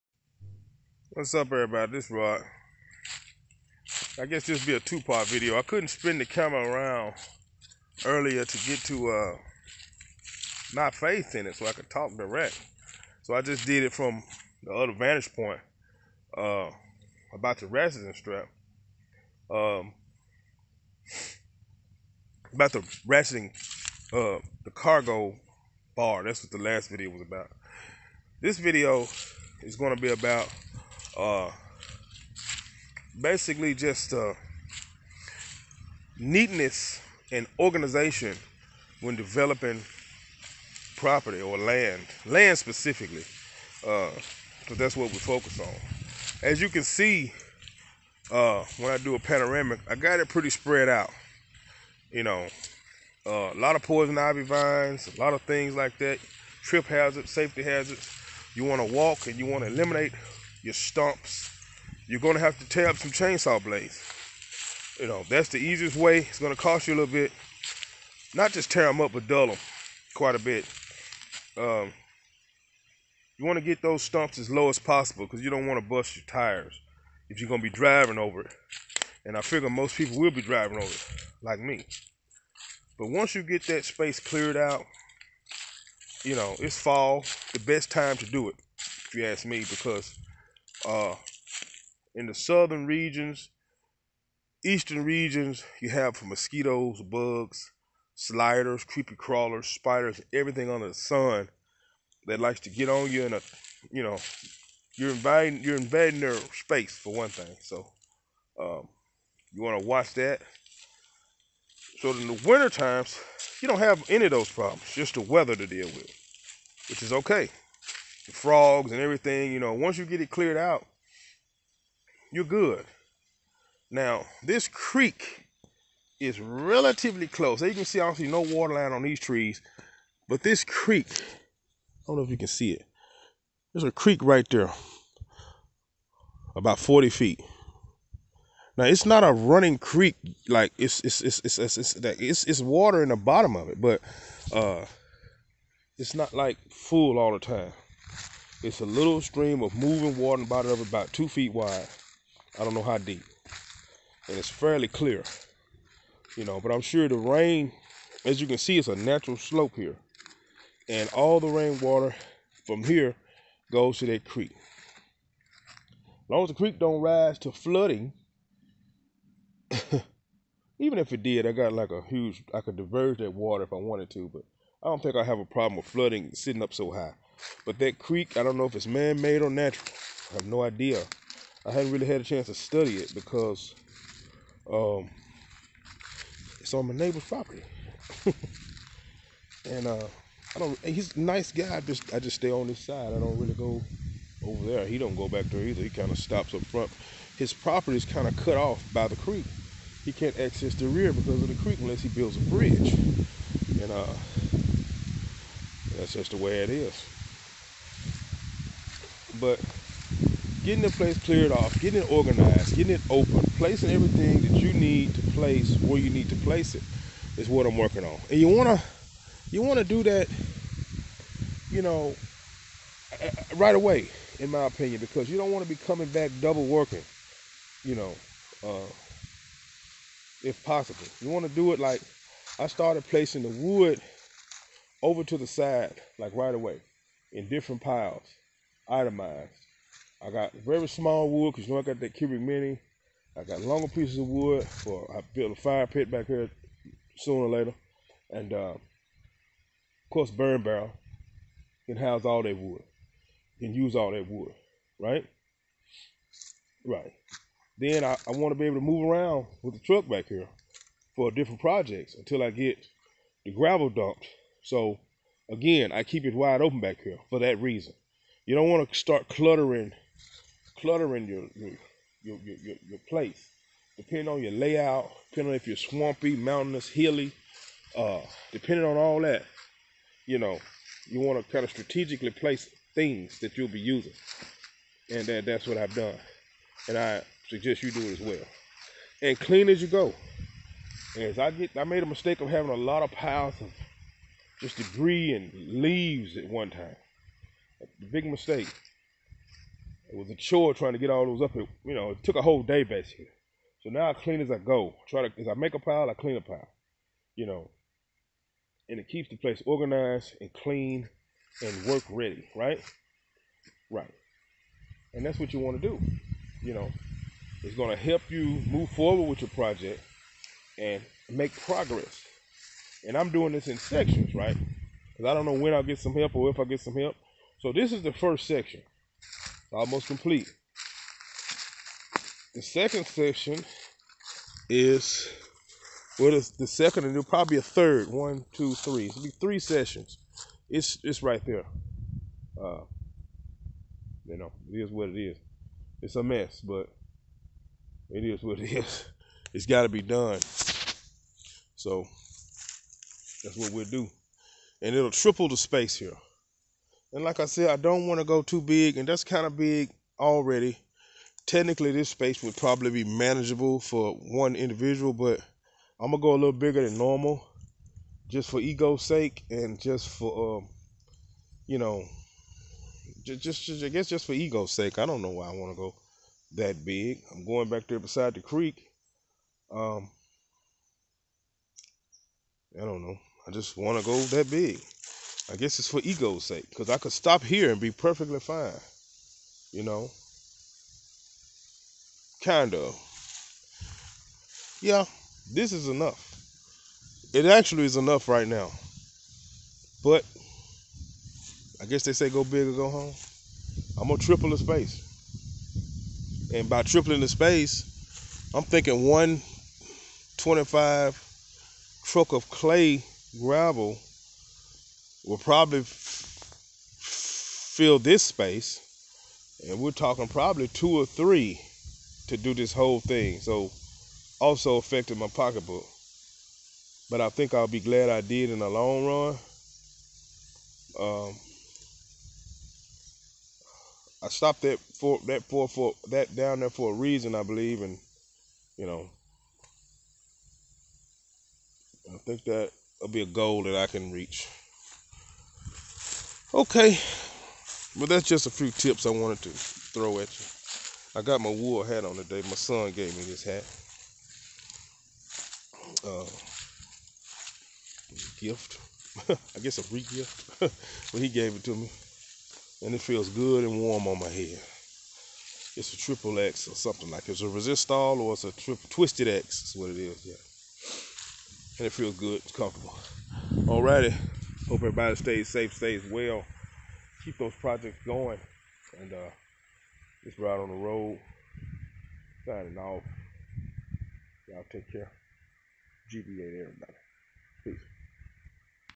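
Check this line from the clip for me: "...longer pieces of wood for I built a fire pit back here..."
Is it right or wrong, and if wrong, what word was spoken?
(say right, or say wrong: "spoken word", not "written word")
right.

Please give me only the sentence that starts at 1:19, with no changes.
And I figure most people will be driving over it, like me.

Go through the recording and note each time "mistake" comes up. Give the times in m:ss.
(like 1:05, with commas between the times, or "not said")
4:52, 4:58.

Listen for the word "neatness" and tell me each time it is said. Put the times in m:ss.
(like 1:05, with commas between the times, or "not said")
0:36.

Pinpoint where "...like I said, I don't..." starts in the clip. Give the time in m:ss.
5:57.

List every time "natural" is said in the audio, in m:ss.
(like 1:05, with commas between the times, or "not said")
2:38, 2:59.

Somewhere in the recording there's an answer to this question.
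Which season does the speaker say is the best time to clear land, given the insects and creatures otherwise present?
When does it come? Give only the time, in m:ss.
1:26.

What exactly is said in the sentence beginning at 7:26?
Okay, but that's just a few tips I wanted to throw at you.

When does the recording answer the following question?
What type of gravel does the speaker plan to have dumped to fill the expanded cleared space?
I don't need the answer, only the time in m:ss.
6:52.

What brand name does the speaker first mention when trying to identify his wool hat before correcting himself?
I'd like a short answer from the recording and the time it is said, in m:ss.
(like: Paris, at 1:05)
Resistol, at 7:47.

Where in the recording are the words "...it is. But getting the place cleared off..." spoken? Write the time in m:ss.
3:26.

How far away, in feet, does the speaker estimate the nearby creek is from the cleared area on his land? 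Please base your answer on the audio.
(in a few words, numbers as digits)
40 feet.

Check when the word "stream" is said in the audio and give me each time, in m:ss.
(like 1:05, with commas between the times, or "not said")
2:29.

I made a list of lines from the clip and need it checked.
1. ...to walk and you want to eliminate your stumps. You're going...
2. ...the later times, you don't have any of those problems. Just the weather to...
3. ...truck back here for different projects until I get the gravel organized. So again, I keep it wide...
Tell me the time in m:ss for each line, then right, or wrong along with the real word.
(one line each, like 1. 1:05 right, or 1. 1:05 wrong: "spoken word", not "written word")
1. 0:58 right
2. 1:52 wrong: "winter", not "later"
3. 4:19 wrong: "dumped", not "organized".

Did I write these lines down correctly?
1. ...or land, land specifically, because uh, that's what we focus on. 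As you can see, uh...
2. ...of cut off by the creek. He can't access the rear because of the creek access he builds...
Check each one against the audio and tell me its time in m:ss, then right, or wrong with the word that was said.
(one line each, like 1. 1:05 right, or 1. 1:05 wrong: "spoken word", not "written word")
1. 0:41 right
2. 3:18 wrong: "unless", not "access".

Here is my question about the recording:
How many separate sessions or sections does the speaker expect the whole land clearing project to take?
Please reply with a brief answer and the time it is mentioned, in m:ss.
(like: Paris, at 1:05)
3, at 5:39.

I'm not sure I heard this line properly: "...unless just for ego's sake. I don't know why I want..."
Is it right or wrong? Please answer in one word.
wrong.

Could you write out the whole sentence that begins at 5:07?
You know, and it keeps the place organized and clean and work ready, right?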